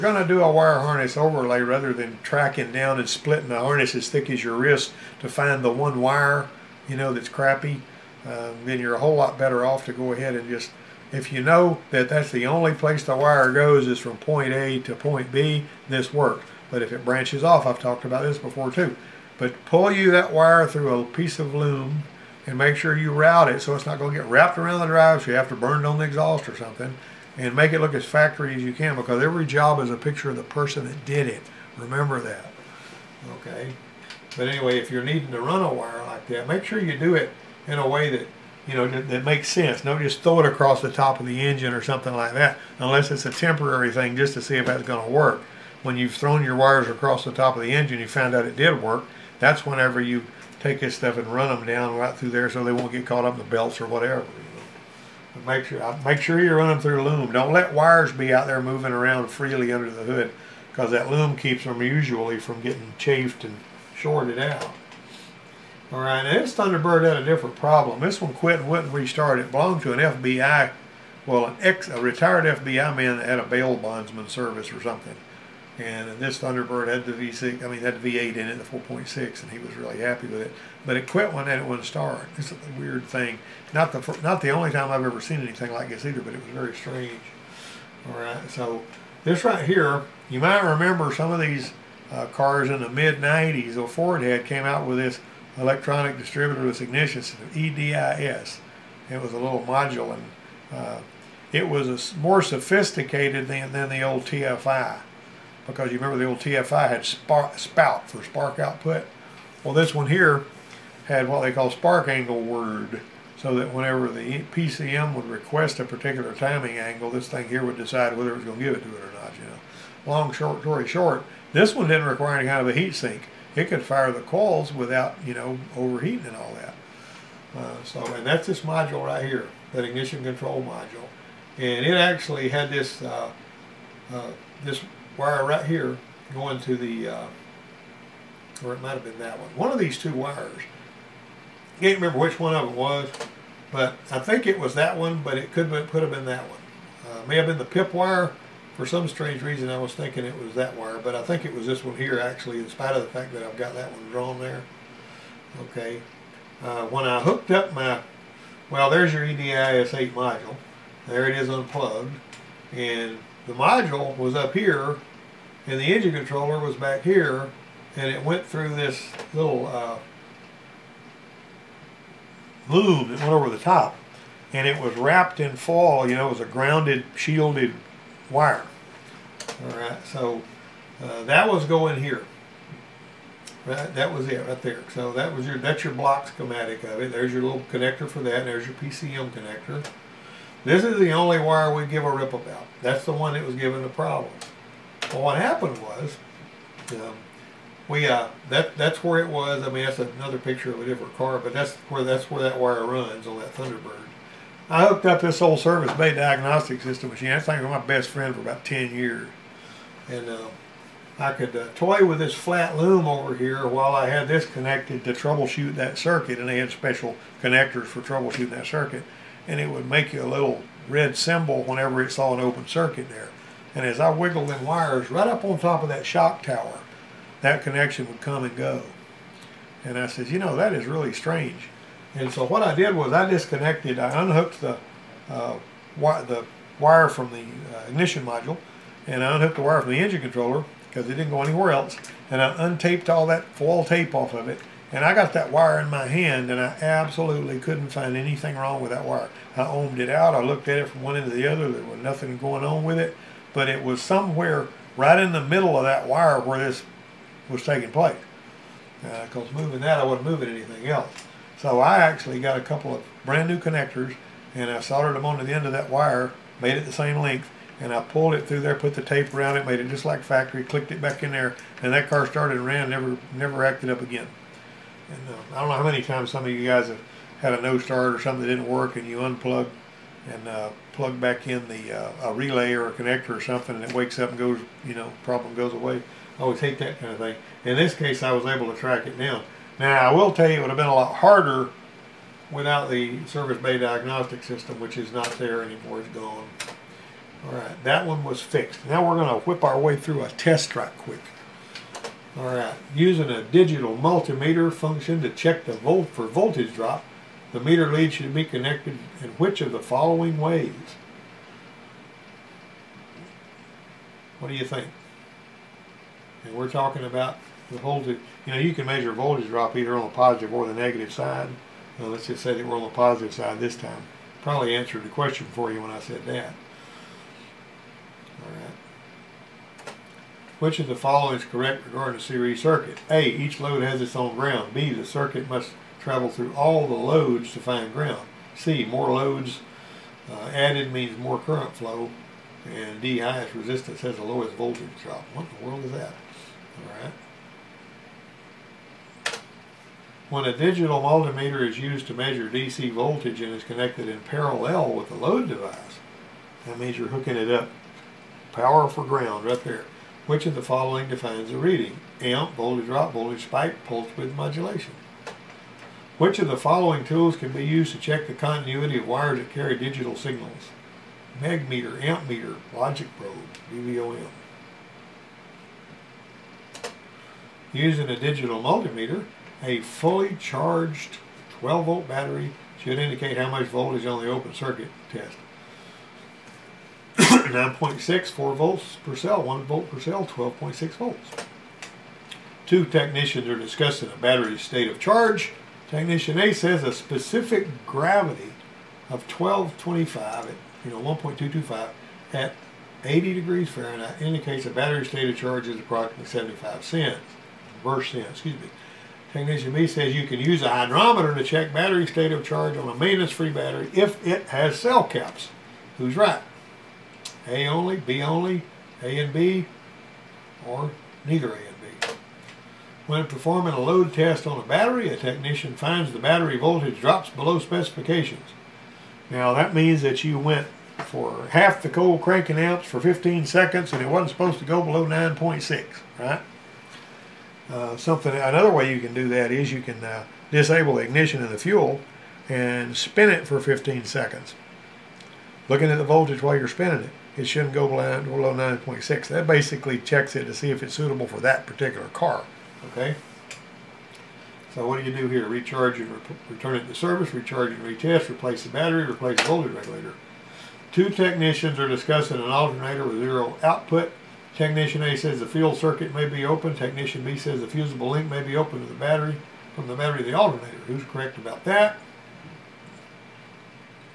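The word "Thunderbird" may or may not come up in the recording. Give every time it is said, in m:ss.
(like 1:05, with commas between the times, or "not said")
1:06, 1:16, 3:23.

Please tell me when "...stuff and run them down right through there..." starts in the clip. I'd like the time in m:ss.
0:50.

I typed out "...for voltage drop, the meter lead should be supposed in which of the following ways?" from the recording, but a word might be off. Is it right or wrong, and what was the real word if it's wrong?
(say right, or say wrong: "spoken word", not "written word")
wrong: "connected", not "supposed".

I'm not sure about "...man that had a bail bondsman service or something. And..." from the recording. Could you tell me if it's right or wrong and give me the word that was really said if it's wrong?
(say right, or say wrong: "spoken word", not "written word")
right.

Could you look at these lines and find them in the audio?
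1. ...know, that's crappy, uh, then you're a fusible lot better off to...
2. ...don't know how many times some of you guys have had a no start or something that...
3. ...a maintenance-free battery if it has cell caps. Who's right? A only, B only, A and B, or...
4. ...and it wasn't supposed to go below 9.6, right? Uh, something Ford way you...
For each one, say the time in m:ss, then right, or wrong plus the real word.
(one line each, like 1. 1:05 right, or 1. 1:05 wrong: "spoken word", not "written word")
1. 0:06 wrong: "whole", not "fusible"
2. 4:35 right
3. 6:52 right
4. 7:13 wrong: "Another", not "Ford".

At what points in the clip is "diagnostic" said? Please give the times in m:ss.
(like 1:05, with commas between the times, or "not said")
3:26, 4:53.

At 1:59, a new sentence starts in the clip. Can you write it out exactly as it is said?
You know, long short story short, this one didn't require any kind of a heat sink.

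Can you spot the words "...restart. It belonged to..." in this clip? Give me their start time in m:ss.
1:08.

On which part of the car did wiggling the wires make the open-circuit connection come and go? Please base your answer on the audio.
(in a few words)
shock tower.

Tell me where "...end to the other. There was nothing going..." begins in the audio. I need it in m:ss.
4:11.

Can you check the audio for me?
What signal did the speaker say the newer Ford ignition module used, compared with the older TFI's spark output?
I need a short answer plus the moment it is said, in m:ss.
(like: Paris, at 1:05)
spark angle word, at 1:51.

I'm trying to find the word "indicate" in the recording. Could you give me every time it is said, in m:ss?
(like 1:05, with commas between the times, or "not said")
6:22, 6:44.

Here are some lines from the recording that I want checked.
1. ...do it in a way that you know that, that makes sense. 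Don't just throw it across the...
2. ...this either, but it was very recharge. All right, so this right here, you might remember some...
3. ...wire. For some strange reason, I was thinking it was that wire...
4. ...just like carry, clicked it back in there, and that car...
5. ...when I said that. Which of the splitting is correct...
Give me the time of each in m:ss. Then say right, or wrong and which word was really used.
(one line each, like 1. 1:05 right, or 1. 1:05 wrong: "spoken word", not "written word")
1. 0:36 right
2. 1:25 wrong: "strange", not "recharge"
3. 2:27 right
4. 4:29 wrong: "factory", not "carry"
5. 5:25 wrong: "following", not "splitting".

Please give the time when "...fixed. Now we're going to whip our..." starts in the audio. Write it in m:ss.
4:58.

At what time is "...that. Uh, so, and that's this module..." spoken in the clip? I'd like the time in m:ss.
2:06.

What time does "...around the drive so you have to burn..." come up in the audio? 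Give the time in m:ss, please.
0:24.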